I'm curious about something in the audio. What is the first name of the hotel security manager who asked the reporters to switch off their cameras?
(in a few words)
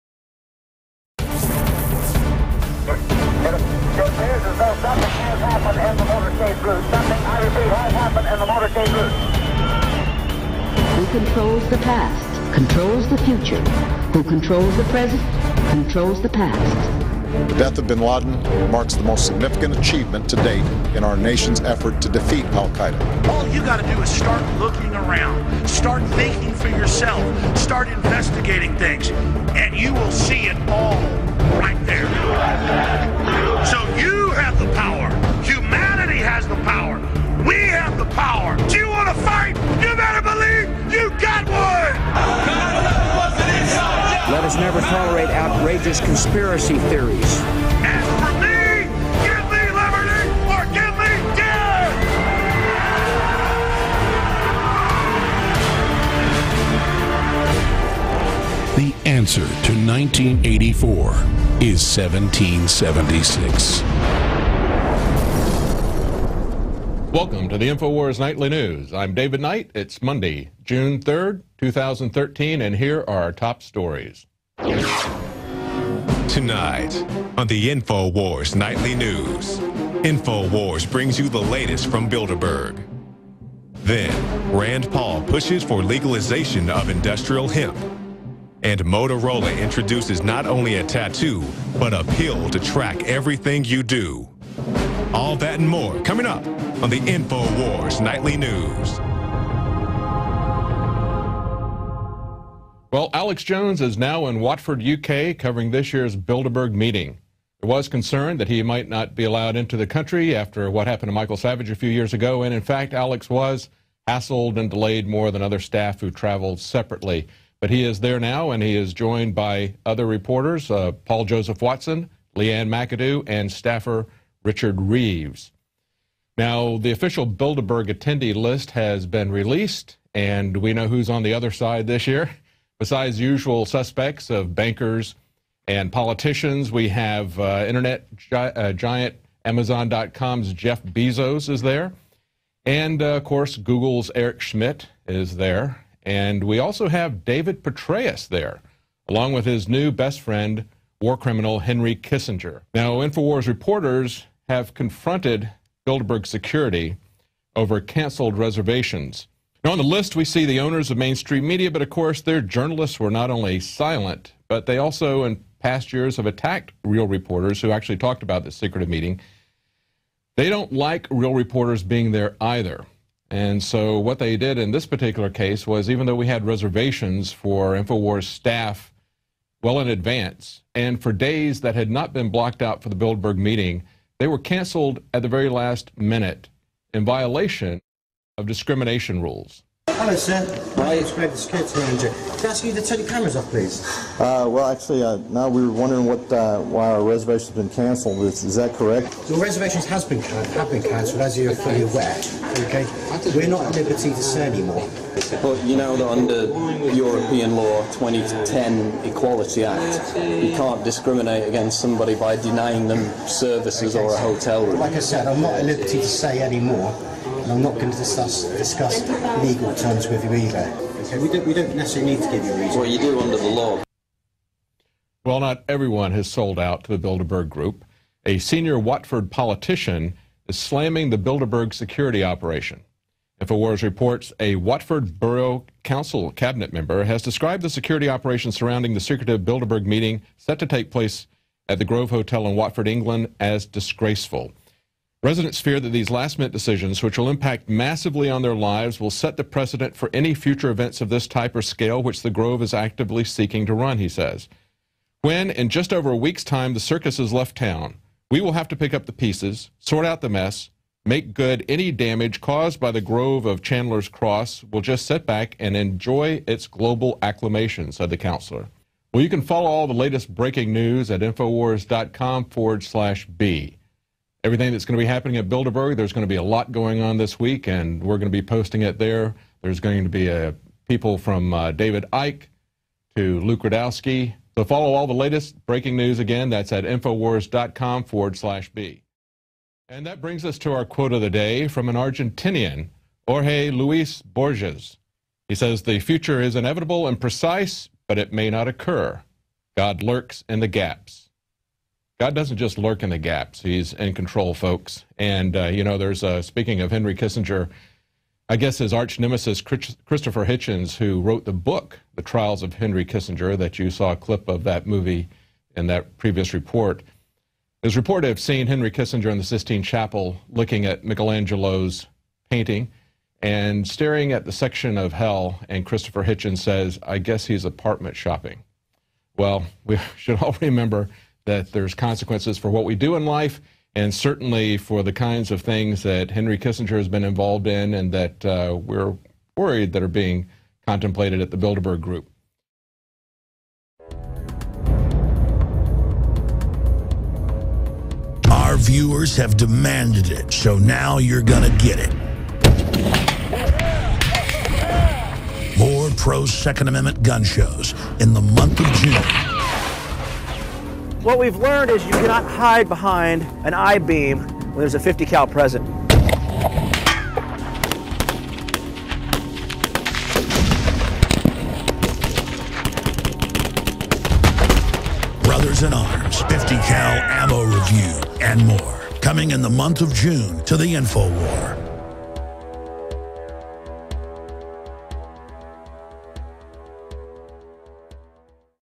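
Greg.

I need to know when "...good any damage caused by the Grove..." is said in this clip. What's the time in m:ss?
4:21.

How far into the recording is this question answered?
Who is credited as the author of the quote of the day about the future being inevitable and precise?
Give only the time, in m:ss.
4:53.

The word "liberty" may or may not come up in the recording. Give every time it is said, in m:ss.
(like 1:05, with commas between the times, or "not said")
3:23, 3:35.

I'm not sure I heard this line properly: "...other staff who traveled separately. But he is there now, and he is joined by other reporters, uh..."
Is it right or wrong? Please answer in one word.
right.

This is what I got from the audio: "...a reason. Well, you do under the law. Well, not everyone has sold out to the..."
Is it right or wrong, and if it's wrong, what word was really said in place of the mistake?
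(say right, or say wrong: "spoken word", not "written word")
right.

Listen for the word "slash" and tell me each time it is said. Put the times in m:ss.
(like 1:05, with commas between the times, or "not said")
4:32, 4:48.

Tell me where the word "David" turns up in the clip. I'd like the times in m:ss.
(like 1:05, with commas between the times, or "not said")
1:09, 2:27, 4:41.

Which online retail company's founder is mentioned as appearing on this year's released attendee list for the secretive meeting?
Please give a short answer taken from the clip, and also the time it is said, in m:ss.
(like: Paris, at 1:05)
Amazon.com, at 2:19.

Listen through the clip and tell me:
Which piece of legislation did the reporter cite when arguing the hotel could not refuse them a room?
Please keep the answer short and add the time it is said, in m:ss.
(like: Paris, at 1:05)
2010 Equality Act, at 3:27.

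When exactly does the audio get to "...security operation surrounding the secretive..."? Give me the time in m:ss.
3:57.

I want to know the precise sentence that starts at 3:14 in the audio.
Uh, well, actually, uh, now we were wondering what uh, why our reservation's been cancelled.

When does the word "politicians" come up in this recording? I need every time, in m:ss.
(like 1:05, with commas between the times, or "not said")
2:15, 3:49.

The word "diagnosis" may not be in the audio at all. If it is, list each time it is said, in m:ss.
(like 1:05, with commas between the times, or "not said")
not said.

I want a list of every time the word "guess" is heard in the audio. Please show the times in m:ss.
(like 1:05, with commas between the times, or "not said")
5:08, 5:27.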